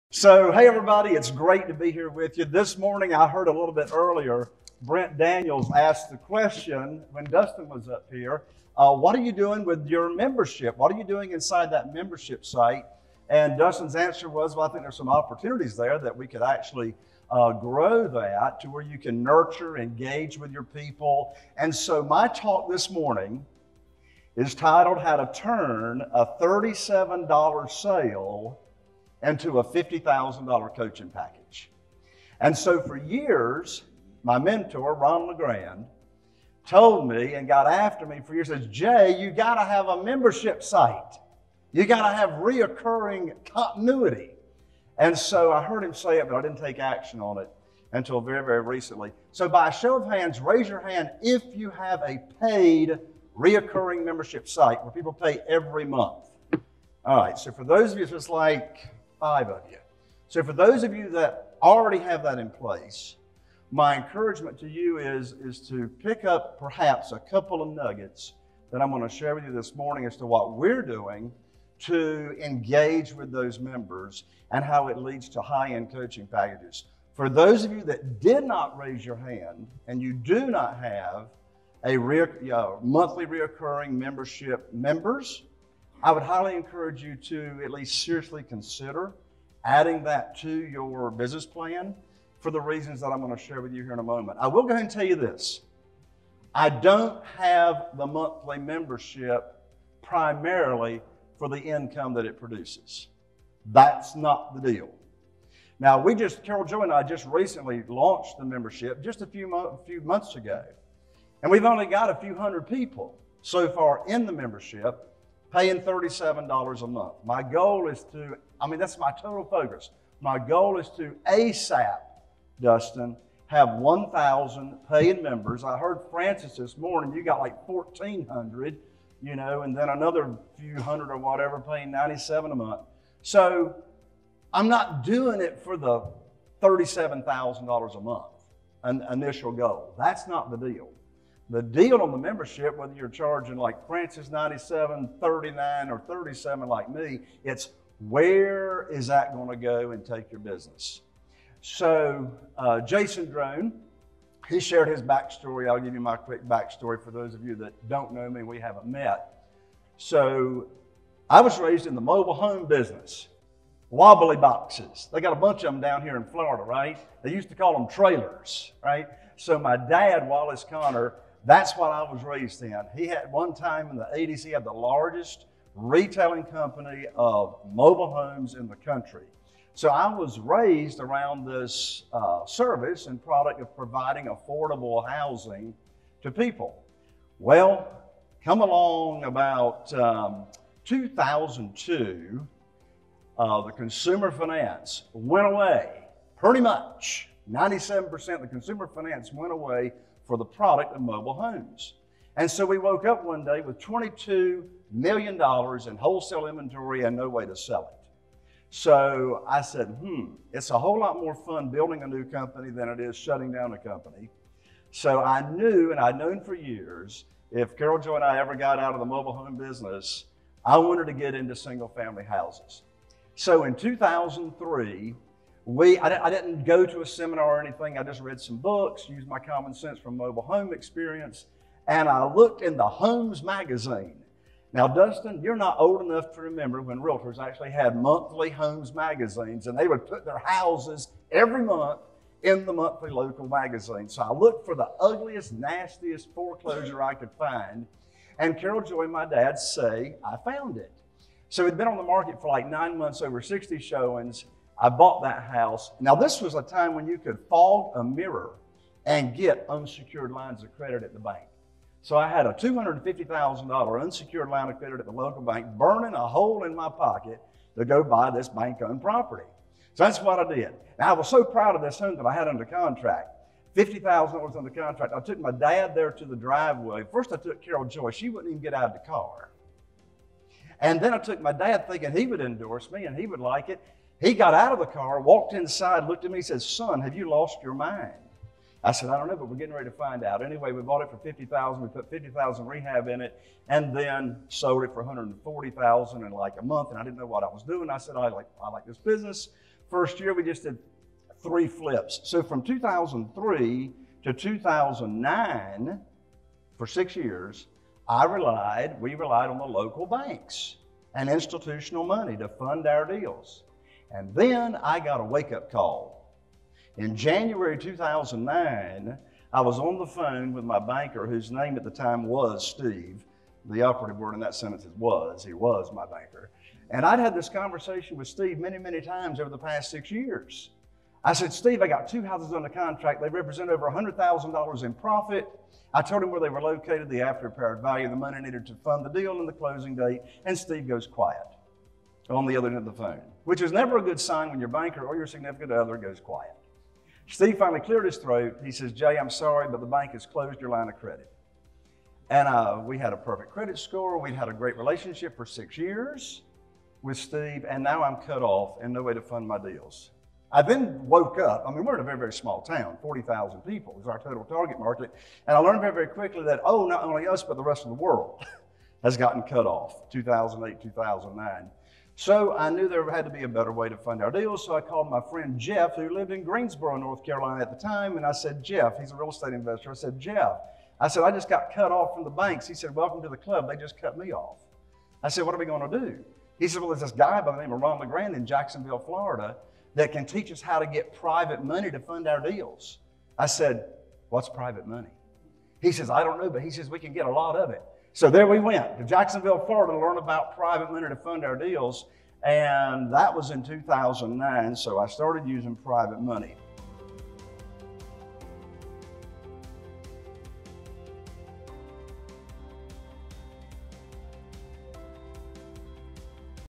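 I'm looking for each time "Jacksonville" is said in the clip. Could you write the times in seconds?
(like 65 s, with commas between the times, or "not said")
388 s, 399 s.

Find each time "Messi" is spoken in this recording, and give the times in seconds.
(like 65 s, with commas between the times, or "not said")
not said.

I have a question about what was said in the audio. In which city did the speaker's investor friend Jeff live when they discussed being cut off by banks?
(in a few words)
Greensboro, North Carolina.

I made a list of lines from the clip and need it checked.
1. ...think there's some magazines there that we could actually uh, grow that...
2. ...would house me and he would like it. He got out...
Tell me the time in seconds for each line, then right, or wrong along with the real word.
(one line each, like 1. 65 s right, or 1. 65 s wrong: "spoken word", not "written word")
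1. 14 s wrong: "opportunities", not "magazines"
2. 282 s wrong: "endorse", not "house".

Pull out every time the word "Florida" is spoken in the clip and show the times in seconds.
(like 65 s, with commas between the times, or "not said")
166 s, 388 s, 399 s.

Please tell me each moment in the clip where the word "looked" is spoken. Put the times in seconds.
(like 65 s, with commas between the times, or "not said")
232 s, 244 s, 286 s.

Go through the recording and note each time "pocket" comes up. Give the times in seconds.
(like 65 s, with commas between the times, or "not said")
266 s.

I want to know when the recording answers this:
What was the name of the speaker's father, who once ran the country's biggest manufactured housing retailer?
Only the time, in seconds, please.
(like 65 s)
170 s.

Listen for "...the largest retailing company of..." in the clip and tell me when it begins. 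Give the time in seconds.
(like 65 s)
174 s.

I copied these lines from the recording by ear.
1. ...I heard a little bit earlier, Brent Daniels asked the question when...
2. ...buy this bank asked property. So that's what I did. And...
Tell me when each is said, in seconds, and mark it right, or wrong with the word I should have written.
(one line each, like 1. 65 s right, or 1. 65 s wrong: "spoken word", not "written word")
1. 3 s right
2. 268 s wrong: "owned", not "asked".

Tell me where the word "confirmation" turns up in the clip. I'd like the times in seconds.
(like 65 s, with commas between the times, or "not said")
not said.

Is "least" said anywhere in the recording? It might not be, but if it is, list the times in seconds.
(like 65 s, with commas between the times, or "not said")
87 s.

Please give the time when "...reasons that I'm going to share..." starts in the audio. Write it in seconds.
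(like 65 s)
92 s.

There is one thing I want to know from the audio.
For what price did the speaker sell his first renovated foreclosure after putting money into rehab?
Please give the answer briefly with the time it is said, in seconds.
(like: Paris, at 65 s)
$140,000, at 295 s.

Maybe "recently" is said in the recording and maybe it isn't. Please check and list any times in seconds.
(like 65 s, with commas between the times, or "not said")
48 s, 107 s.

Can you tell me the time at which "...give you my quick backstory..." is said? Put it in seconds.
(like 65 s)
155 s.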